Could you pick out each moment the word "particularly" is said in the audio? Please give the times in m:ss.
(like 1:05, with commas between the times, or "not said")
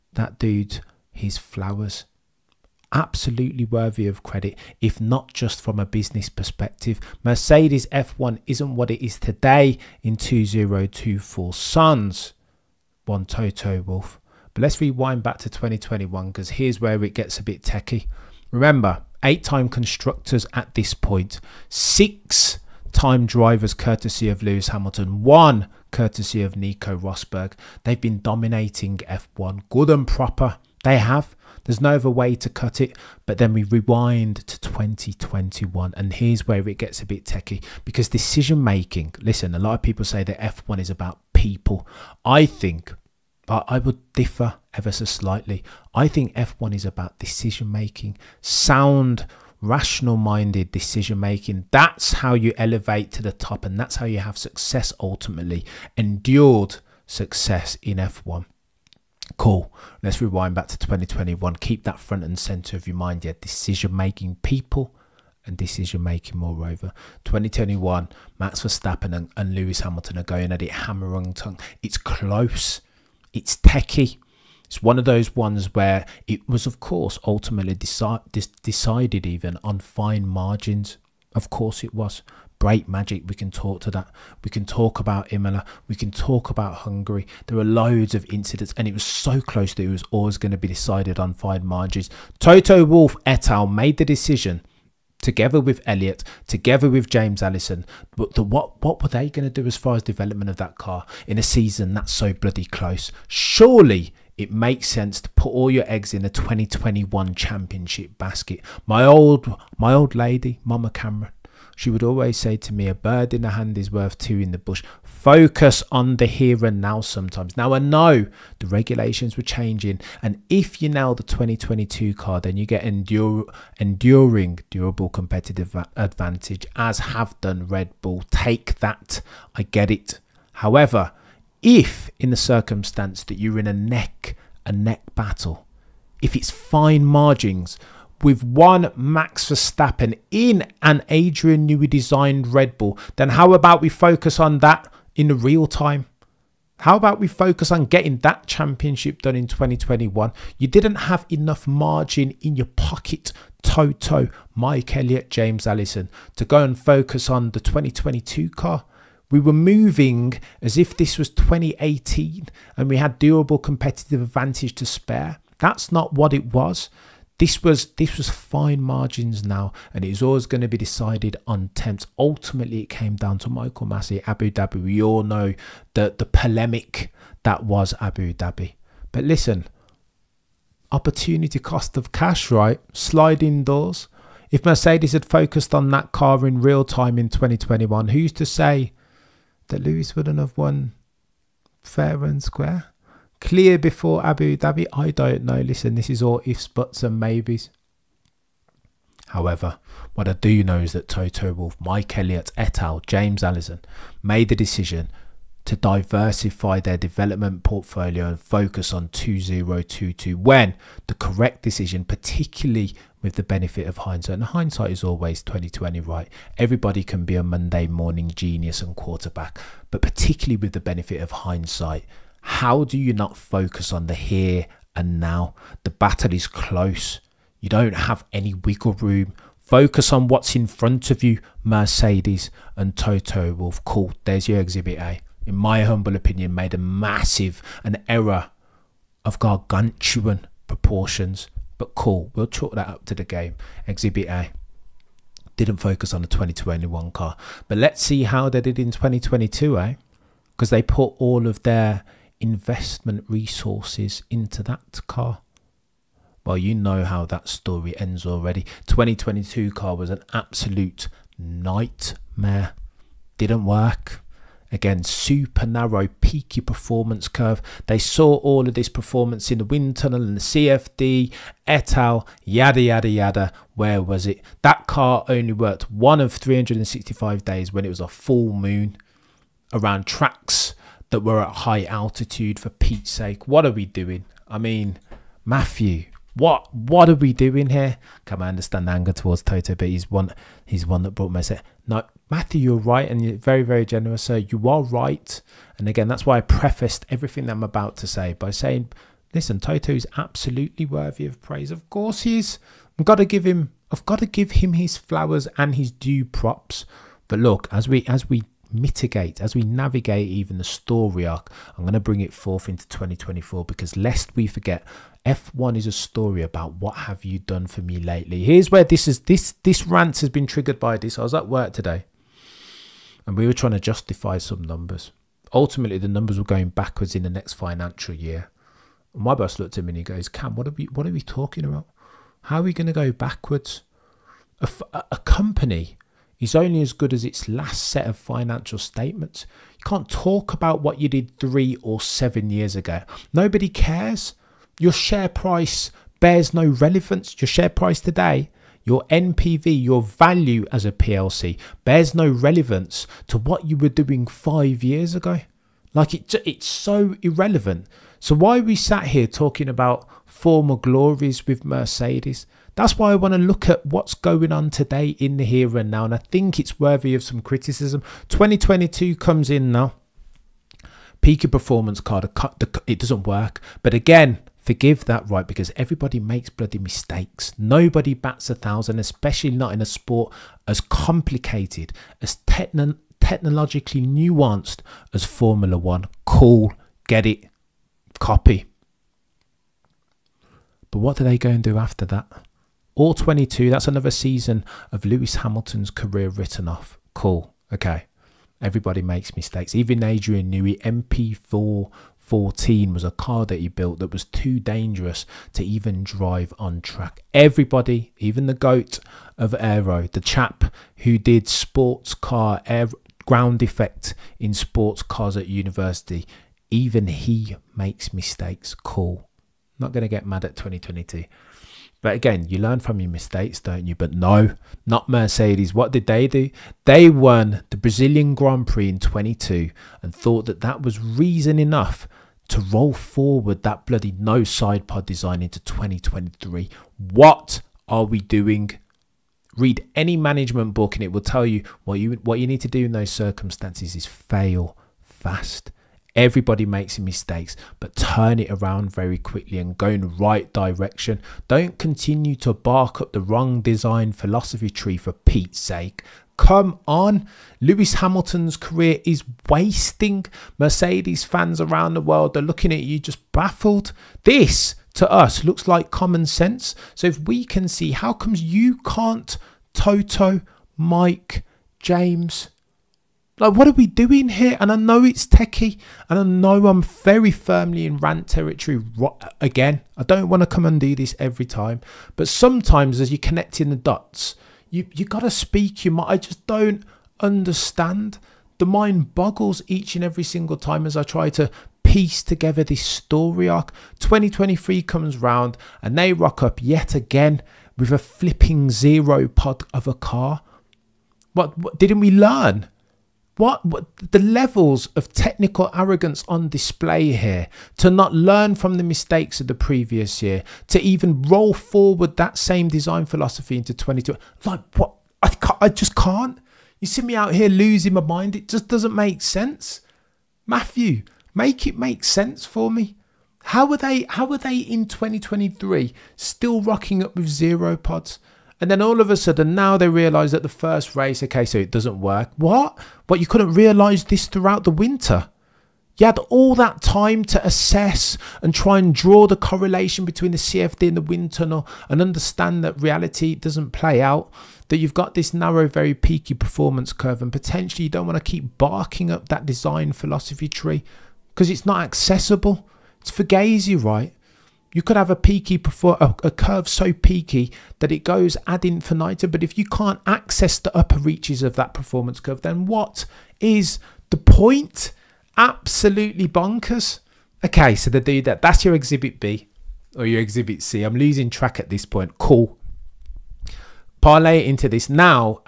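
3:32, 3:40.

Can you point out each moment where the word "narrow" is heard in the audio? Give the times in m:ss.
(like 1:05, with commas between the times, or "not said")
4:25, 9:05.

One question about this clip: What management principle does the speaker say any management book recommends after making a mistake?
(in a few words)
Fail fast.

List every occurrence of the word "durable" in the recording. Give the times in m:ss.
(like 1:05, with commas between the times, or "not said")
2:04, 2:43.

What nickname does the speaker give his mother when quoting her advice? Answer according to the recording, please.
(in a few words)
Mama Cameron.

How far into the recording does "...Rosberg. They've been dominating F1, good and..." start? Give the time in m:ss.
0:26.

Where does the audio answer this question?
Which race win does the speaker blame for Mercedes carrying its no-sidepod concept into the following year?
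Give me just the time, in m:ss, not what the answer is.
7:07.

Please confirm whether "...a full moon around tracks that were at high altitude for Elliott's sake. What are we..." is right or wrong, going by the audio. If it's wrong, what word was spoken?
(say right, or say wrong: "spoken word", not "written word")
wrong: "Pete", not "Elliott".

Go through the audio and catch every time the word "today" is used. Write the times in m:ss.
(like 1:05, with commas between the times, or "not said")
0:09, 5:21, 5:48, 6:04.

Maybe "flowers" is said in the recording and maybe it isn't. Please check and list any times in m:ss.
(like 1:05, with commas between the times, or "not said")
0:01, 5:04.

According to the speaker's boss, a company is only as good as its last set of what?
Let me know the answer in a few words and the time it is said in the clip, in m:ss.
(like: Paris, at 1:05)
Financial statements, at 5:38.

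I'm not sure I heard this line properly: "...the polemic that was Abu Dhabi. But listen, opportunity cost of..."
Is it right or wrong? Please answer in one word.
right.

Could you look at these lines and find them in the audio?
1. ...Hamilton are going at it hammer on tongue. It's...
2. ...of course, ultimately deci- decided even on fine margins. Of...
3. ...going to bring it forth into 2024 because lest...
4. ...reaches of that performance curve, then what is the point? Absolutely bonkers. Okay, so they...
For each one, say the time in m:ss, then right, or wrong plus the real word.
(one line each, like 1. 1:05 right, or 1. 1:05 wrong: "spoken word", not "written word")
1. 1:09 right
2. 1:16 right
3. 5:11 right
4. 9:20 right.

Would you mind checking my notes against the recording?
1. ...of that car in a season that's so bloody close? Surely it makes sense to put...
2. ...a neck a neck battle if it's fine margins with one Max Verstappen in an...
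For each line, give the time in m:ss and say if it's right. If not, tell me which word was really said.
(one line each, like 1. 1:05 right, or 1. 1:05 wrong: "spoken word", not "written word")
1. 1:40 right
2. 2:13 right.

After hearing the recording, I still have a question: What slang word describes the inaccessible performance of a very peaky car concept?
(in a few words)
Fugazi.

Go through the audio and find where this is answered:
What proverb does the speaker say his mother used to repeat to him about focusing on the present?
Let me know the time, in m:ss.
1:52.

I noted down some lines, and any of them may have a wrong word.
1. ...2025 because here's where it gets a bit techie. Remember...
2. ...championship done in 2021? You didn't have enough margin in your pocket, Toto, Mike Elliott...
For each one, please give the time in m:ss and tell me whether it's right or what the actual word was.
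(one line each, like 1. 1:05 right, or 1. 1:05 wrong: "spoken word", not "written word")
1. 0:15 wrong: "2021", not "2025"
2. 2:28 right.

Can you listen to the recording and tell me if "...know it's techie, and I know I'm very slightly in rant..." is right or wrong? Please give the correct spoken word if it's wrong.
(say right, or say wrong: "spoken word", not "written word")
wrong: "firmly", not "slightly".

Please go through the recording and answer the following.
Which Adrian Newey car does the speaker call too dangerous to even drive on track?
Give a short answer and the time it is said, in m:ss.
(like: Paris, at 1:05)
MP4 14, at 6:40.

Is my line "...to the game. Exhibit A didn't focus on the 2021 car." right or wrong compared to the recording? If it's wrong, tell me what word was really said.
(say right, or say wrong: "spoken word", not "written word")
right.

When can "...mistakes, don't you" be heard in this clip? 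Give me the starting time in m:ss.
7:03.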